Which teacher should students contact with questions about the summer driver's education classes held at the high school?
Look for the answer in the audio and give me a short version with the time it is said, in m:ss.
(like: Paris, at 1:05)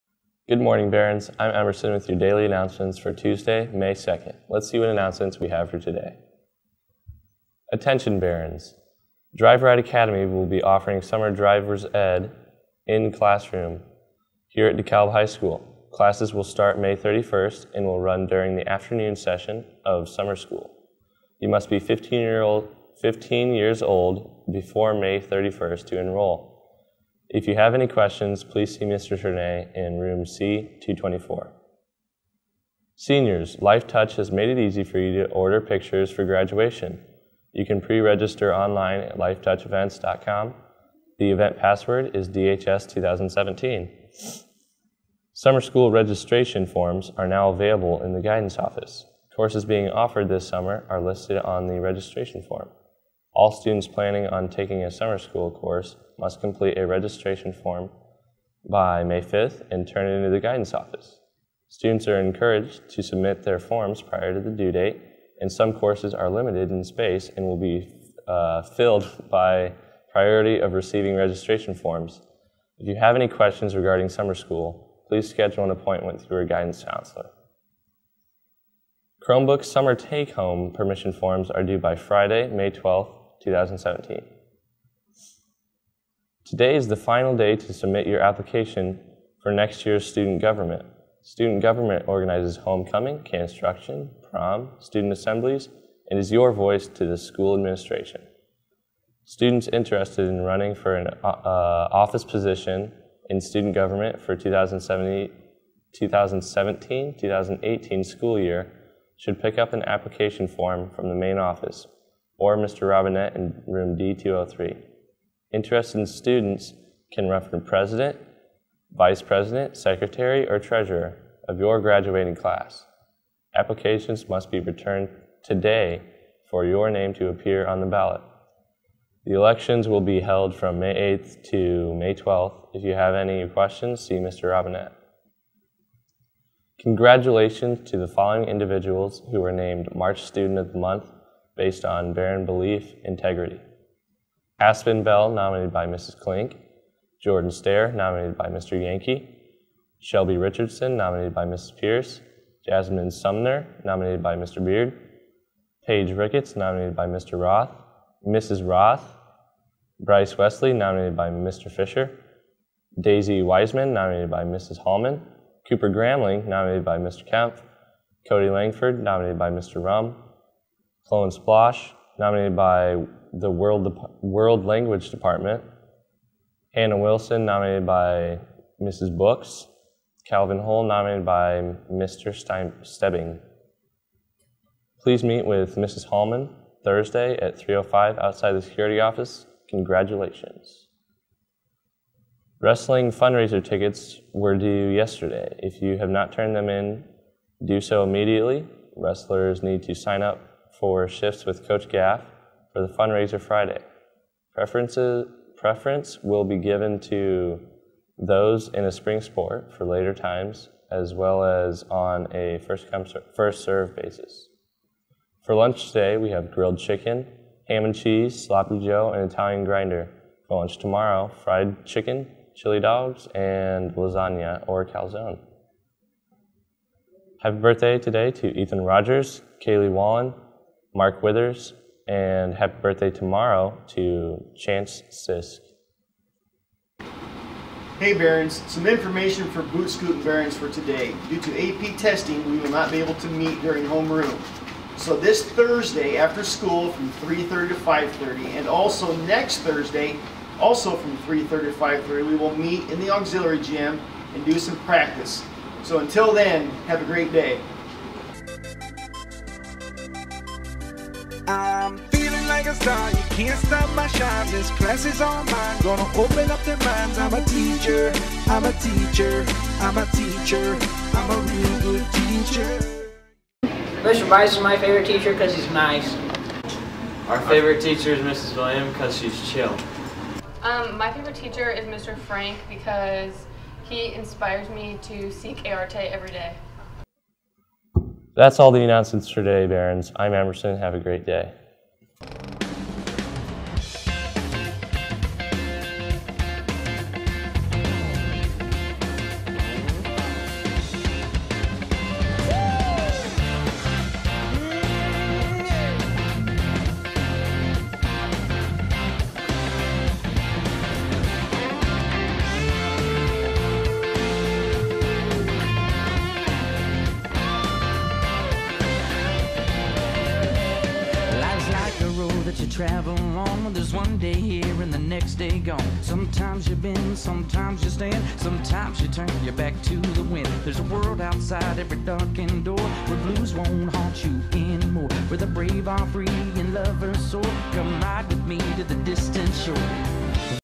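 Mr. Chernay, at 0:28.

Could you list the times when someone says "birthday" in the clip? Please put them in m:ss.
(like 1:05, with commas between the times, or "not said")
3:47, 3:52.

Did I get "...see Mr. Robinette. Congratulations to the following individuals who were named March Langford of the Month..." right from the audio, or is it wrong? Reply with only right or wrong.
wrong.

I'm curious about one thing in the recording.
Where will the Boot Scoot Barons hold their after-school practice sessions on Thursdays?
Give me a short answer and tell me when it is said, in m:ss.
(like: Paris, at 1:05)
auxiliary gym, at 4:13.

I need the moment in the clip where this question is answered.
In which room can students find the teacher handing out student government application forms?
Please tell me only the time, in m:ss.
1:53.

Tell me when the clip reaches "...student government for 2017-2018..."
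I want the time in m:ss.
1:43.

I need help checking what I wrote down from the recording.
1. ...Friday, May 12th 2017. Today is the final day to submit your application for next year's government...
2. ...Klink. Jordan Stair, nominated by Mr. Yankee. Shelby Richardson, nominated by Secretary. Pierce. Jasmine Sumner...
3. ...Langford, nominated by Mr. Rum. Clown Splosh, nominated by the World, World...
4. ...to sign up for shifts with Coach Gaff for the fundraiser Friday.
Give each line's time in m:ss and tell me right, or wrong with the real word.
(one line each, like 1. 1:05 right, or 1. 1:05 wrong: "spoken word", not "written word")
1. 1:21 wrong: "student", not "government"
2. 2:26 wrong: "Mrs", not "Secretary"
3. 2:48 right
4. 3:19 right.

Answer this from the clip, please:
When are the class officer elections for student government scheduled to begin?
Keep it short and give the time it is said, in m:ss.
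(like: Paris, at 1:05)
May 8th, at 2:10.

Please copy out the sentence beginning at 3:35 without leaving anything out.
For lunch today, we have grilled chicken, ham and cheese, sloppy joe, and Italian grinder.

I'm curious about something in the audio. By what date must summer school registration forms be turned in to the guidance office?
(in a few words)
May 5th.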